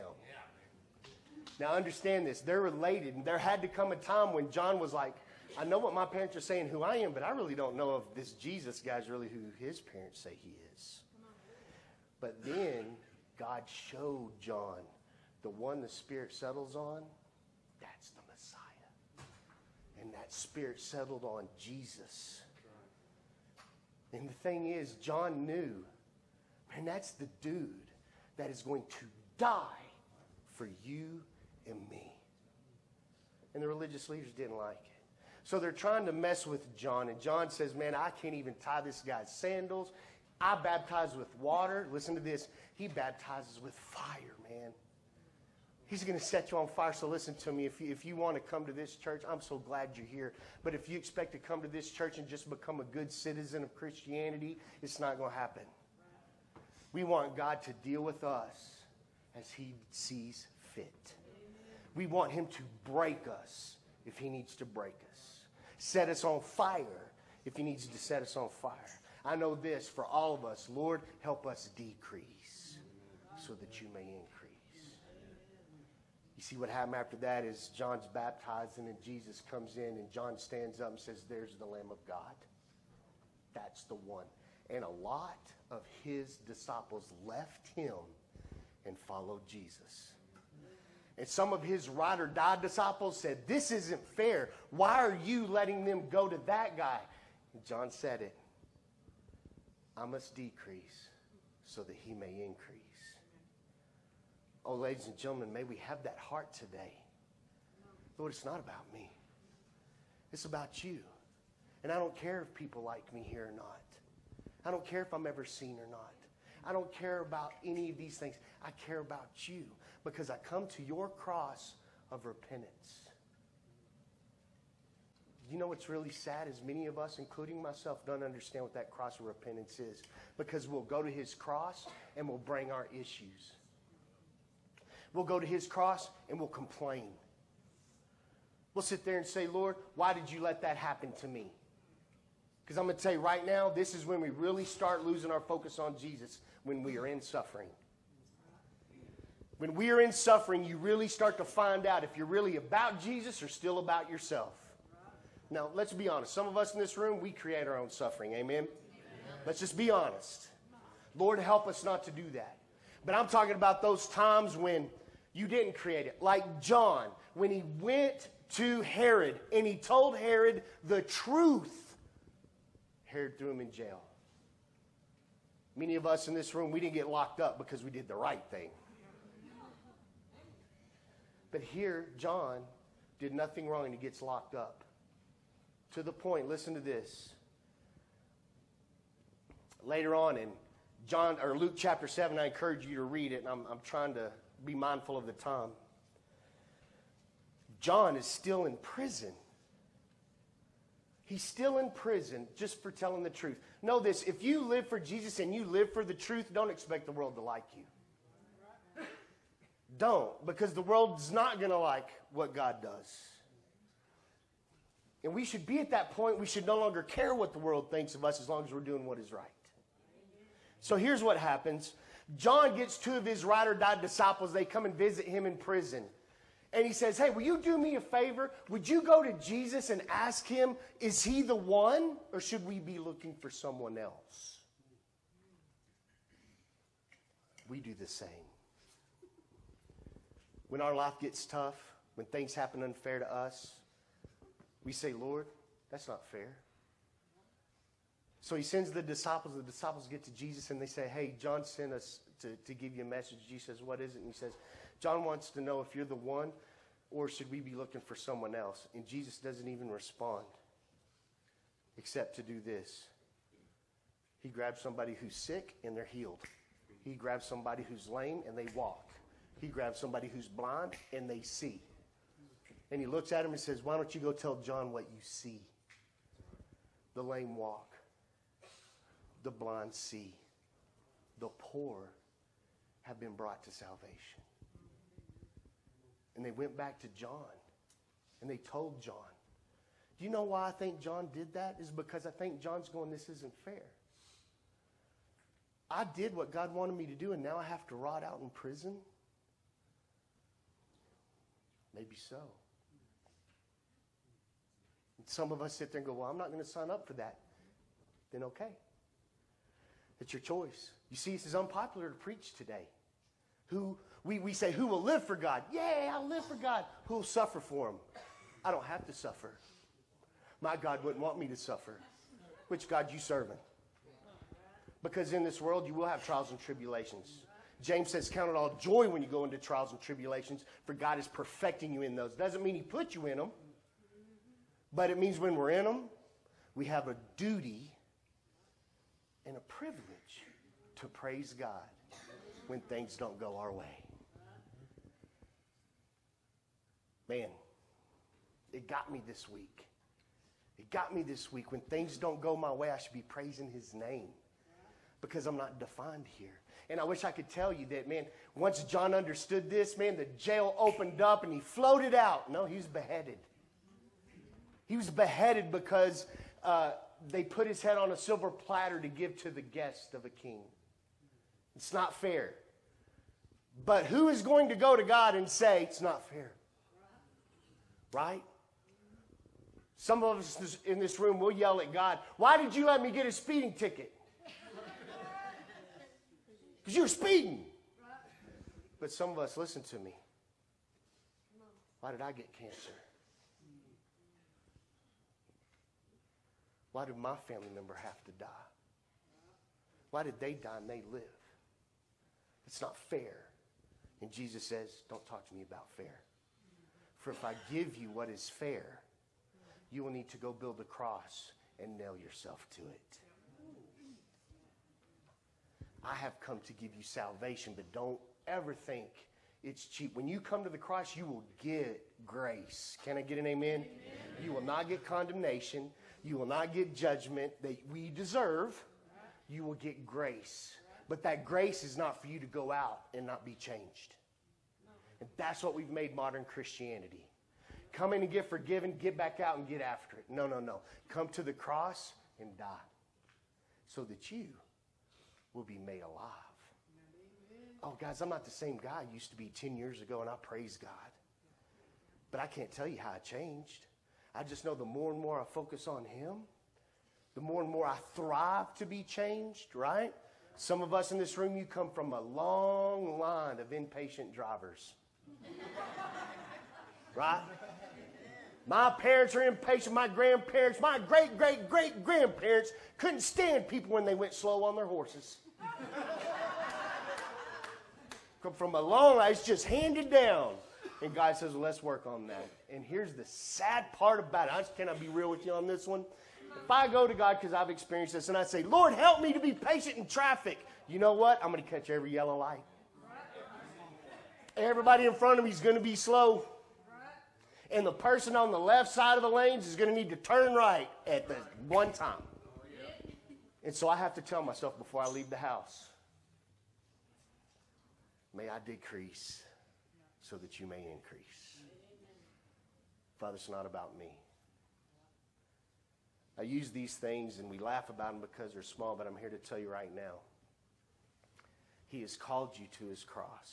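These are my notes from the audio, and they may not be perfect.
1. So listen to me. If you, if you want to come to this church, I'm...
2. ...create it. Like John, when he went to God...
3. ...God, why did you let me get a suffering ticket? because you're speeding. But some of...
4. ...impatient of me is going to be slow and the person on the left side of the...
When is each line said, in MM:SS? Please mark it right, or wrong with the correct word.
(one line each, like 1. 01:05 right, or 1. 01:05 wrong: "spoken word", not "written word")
1. 00:46 right
2. 02:45 wrong: "Herod", not "God"
3. 06:21 wrong: "speeding", not "suffering"
4. 08:15 wrong: "front", not "impatient".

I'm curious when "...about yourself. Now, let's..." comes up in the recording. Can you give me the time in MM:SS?
02:33.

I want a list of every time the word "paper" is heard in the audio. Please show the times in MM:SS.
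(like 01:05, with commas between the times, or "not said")
not said.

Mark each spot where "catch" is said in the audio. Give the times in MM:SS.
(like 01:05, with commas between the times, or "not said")
08:11.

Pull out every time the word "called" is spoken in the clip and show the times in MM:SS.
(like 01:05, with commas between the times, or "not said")
08:42.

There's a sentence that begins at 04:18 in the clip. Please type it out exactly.
And Jesus doesn't even respond except to do this.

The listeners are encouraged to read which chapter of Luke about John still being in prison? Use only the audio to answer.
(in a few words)
Luke chapter 7.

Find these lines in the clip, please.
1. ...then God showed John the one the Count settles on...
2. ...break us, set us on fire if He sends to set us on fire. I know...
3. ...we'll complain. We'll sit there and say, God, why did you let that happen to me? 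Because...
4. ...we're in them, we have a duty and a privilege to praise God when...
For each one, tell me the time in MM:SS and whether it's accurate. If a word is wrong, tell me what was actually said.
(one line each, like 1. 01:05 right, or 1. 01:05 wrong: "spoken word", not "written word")
1. 00:12 wrong: "Spirit", not "Count"
2. 01:04 wrong: "needs", not "sends"
3. 02:16 wrong: "Lord", not "God"
4. 05:35 right.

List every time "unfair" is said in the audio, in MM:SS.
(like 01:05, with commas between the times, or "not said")
04:02.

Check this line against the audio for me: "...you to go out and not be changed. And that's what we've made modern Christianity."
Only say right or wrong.
right.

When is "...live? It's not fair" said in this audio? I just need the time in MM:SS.
06:41.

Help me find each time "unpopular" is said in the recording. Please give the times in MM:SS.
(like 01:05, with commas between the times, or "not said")
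05:11.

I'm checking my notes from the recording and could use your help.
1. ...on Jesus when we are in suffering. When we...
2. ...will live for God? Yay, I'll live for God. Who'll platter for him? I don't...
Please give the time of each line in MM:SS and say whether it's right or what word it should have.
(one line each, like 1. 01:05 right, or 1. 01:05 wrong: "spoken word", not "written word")
1. 02:25 right
2. 05:14 wrong: "suffer", not "platter".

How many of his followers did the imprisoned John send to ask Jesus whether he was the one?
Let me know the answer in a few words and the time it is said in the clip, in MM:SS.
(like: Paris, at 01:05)
2, at 03:42.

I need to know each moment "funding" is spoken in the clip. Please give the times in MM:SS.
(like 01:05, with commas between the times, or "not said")
not said.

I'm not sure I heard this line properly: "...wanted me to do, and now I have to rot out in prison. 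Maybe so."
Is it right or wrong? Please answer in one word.
right.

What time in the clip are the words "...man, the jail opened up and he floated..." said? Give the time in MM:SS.
05:59.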